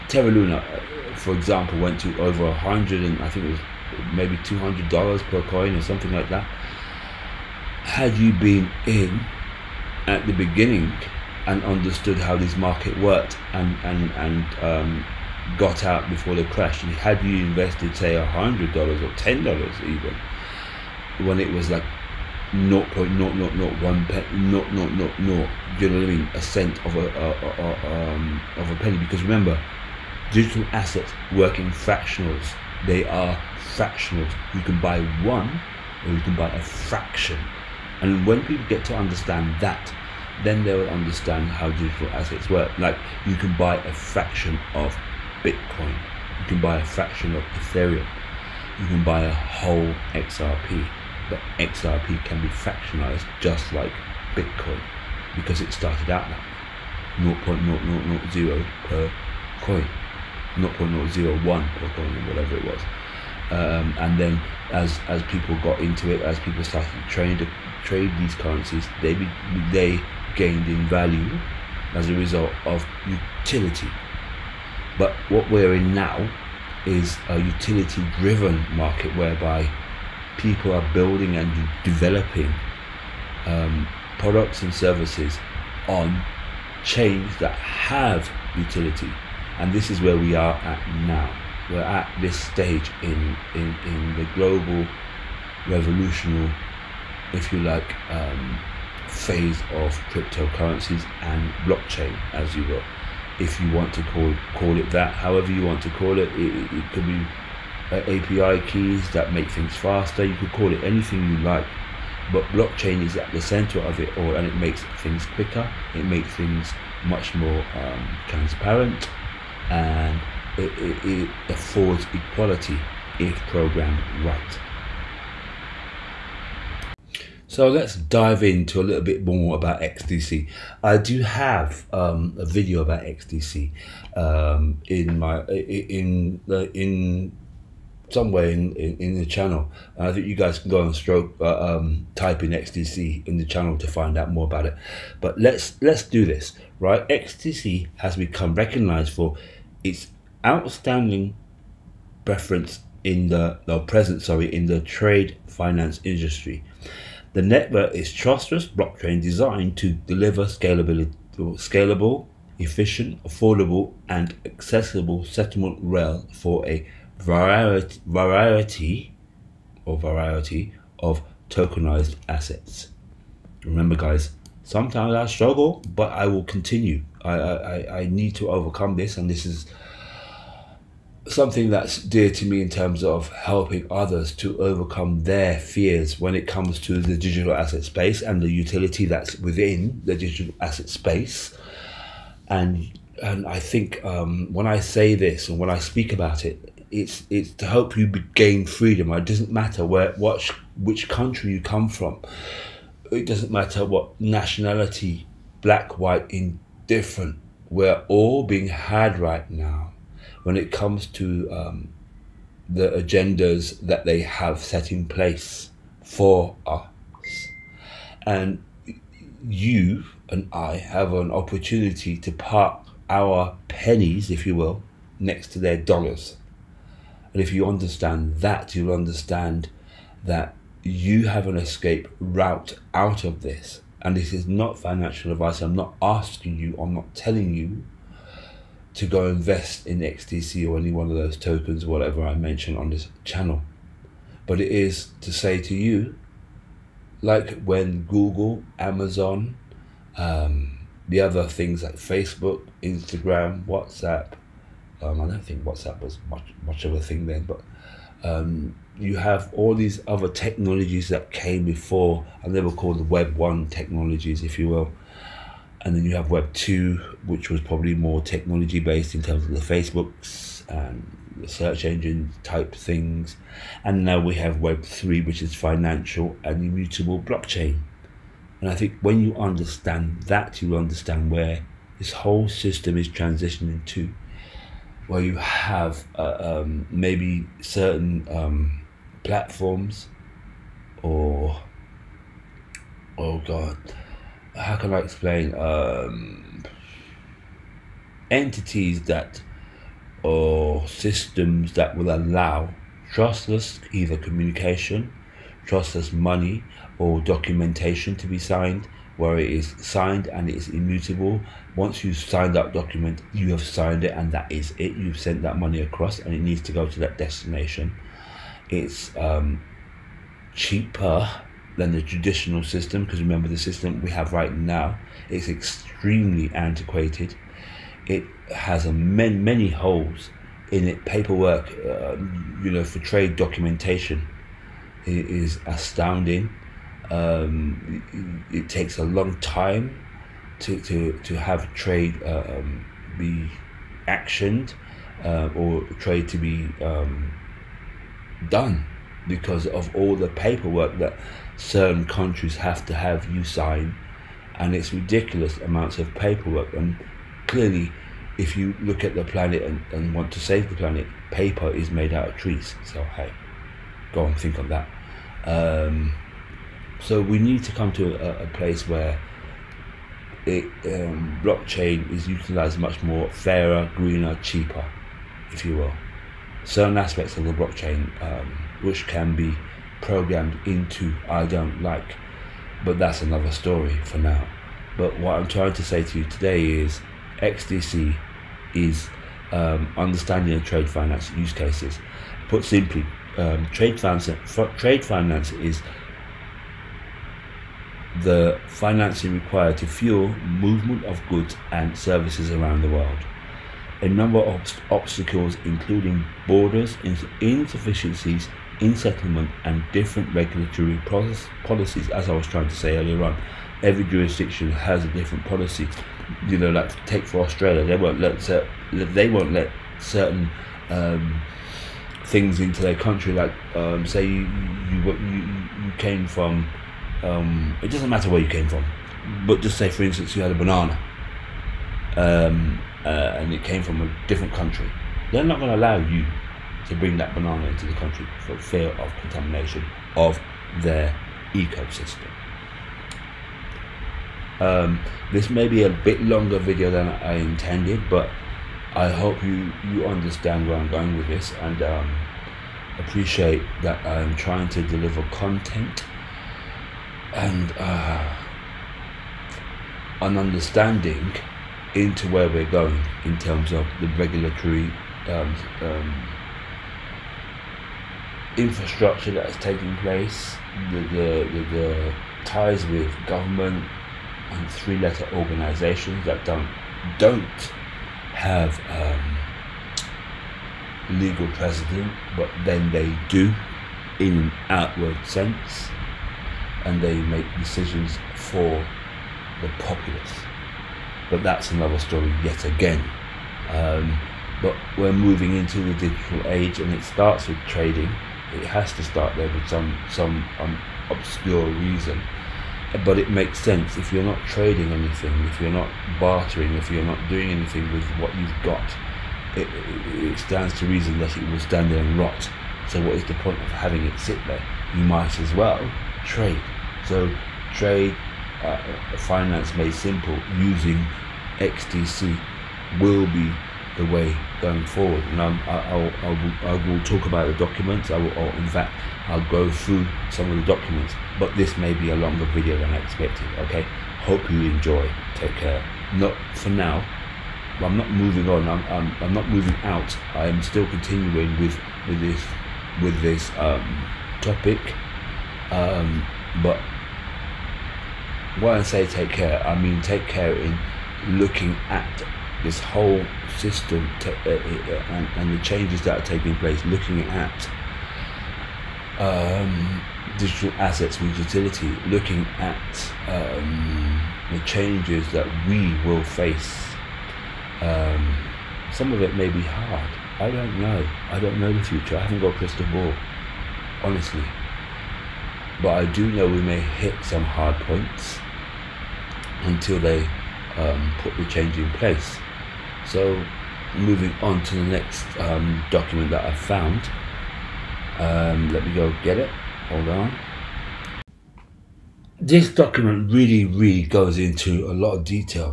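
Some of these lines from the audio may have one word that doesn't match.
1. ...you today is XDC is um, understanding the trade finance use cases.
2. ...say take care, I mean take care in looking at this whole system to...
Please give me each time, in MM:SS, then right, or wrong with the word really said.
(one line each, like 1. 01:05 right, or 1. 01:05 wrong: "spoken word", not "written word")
1. 06:26 right
2. 09:08 right.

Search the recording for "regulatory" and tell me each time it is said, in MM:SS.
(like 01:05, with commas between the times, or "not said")
06:50, 07:44.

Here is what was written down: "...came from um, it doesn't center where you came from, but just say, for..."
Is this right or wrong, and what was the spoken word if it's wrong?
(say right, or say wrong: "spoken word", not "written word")
wrong: "matter", not "center".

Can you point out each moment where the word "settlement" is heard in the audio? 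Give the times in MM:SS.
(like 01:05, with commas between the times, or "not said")
02:45, 06:48.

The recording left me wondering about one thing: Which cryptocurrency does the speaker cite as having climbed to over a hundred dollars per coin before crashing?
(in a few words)
Terra Luna.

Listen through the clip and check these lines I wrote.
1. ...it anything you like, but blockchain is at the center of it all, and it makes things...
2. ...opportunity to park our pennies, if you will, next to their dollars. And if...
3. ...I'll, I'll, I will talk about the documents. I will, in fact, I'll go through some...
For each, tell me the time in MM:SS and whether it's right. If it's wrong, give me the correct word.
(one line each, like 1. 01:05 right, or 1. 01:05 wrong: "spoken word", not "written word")
1. 01:50 right
2. 03:41 right
3. 08:45 right.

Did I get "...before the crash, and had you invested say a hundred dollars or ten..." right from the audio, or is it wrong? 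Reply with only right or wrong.
right.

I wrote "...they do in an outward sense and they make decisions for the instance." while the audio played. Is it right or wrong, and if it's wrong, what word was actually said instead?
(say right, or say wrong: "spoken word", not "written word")
wrong: "populace", not "instance".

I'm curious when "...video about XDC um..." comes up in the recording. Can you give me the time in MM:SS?
02:12.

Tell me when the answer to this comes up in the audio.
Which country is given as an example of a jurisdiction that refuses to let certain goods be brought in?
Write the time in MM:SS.
06:57.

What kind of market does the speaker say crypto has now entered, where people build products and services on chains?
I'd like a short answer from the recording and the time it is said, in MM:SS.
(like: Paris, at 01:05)
utility driven market, at 01:17.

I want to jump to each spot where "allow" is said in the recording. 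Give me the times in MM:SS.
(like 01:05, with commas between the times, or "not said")
05:02, 07:15.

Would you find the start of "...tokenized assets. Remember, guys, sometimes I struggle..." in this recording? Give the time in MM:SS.
02:51.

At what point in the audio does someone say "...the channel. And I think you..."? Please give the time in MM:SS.
02:19.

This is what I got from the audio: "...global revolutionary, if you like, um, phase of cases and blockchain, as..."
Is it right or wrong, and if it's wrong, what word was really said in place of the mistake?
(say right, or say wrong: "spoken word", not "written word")
wrong: "cryptocurrencies", not "cases".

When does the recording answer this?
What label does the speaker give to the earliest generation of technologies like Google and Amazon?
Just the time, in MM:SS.
04:23.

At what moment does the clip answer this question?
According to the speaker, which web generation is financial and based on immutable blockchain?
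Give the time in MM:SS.
04:34.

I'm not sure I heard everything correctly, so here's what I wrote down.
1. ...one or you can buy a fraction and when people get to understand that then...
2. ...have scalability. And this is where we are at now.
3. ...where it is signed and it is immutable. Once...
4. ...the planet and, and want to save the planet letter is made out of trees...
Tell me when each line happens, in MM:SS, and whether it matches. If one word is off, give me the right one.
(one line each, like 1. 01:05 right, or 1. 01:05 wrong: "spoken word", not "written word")
1. 00:35 right
2. 01:27 wrong: "utility", not "scalability"
3. 05:09 right
4. 05:59 wrong: "paper", not "letter".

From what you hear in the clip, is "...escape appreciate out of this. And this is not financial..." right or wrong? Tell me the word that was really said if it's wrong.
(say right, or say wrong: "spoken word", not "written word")
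wrong: "route", not "appreciate".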